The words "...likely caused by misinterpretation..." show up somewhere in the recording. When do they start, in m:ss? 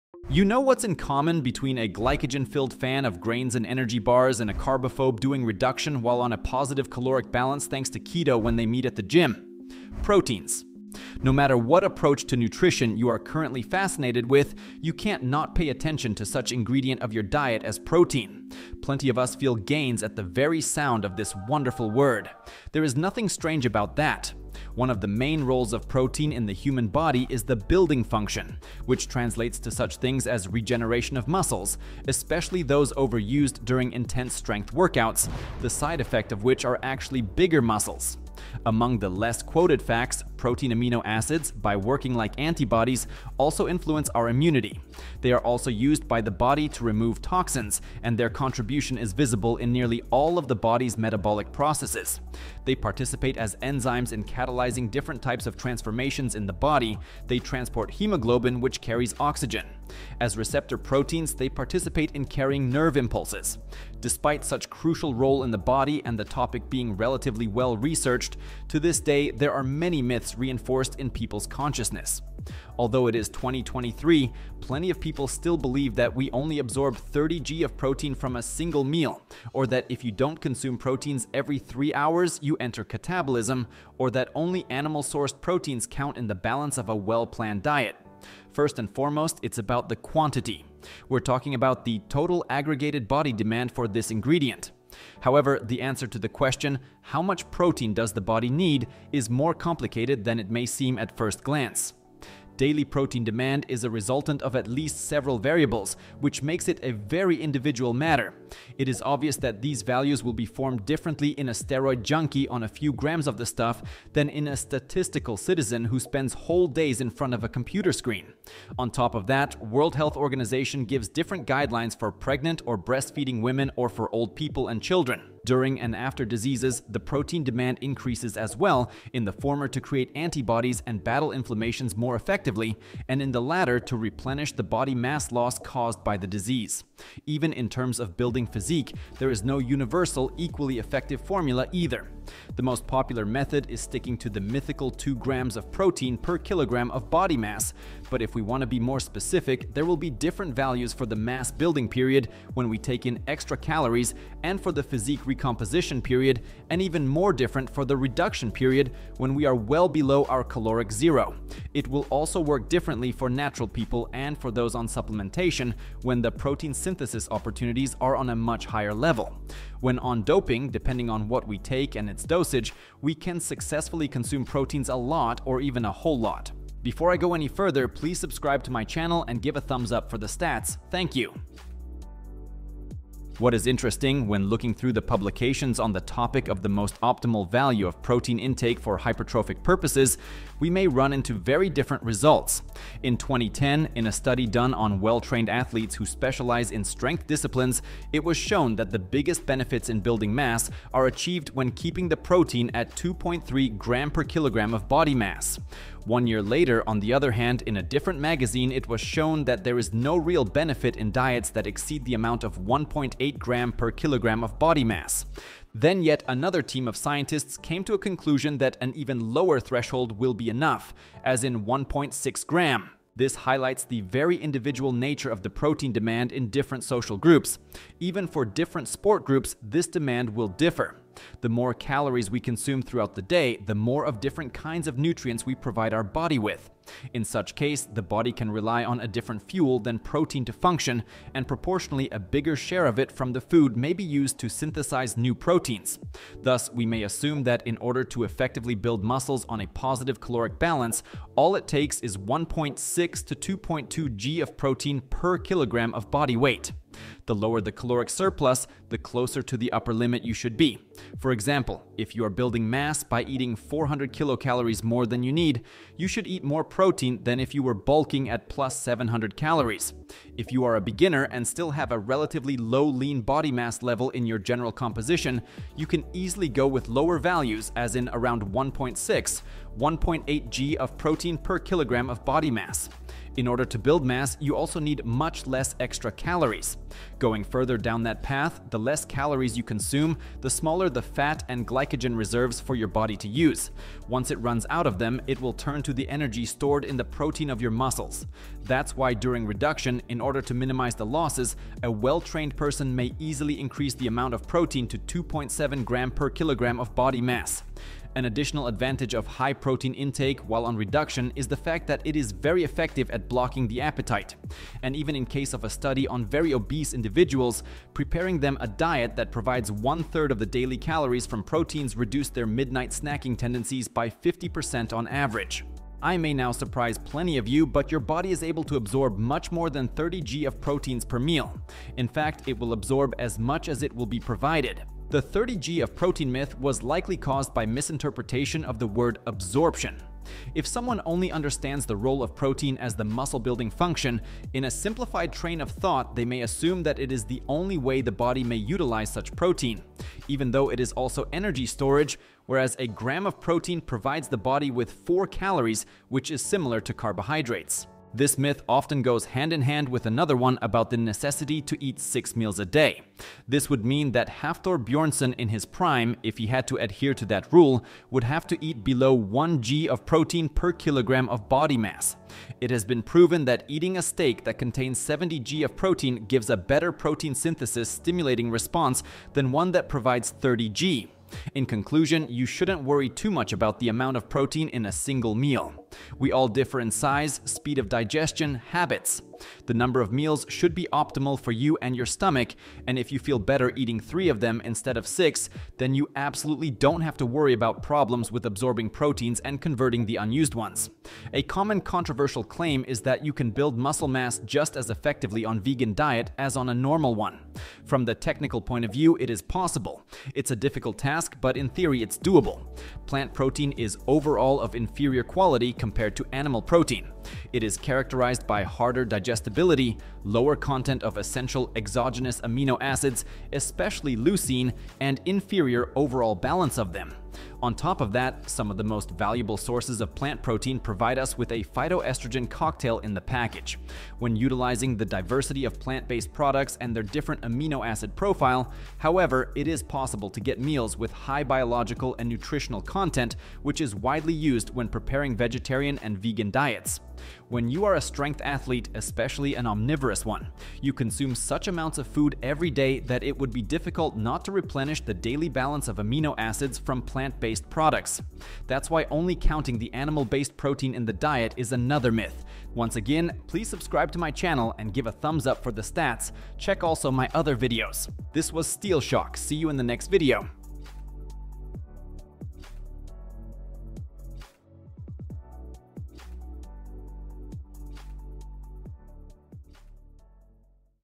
5:36.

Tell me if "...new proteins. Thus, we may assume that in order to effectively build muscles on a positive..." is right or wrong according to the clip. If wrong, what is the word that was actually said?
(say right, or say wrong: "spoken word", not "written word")
right.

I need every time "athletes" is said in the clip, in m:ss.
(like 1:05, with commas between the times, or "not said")
3:15, 7:28.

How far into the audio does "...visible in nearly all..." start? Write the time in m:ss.
0:49.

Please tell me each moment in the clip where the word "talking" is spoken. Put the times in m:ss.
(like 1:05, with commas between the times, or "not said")
1:31.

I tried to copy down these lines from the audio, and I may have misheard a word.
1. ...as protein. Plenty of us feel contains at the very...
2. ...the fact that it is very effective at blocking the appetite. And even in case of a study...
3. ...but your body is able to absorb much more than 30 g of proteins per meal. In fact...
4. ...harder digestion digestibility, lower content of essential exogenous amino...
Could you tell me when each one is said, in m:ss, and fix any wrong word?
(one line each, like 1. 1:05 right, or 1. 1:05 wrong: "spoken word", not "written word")
1. 0:17 wrong: "gains", not "contains"
2. 5:11 right
3. 5:27 right
4. 6:58 right.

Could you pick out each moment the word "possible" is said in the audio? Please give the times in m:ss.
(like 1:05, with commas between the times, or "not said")
6:49, 7:19.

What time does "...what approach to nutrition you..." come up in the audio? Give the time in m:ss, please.
0:11.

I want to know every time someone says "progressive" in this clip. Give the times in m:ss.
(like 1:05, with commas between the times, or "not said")
not said.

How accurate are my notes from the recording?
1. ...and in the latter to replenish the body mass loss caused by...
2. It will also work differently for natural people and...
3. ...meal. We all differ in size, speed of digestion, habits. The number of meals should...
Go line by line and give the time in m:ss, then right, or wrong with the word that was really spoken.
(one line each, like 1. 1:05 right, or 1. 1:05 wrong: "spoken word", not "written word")
1. 2:13 right
2. 2:41 right
3. 6:25 right.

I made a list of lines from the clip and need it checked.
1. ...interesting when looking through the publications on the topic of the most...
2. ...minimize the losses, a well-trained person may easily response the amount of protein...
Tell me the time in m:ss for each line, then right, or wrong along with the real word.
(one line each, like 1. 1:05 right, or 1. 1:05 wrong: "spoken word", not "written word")
1. 3:03 right
2. 5:00 wrong: "increase", not "response".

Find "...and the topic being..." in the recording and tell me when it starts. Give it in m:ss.
1:06.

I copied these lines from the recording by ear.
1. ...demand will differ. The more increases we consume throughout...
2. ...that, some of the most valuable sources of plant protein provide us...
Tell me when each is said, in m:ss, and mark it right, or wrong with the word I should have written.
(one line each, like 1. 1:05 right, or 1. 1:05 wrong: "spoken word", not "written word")
1. 3:49 wrong: "calories", not "increases"
2. 7:08 right.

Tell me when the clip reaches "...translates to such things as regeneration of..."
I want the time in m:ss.
0:29.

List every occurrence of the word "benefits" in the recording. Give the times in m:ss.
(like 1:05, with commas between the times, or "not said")
3:19, 3:30.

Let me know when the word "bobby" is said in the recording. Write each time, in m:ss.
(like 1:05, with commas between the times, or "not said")
not said.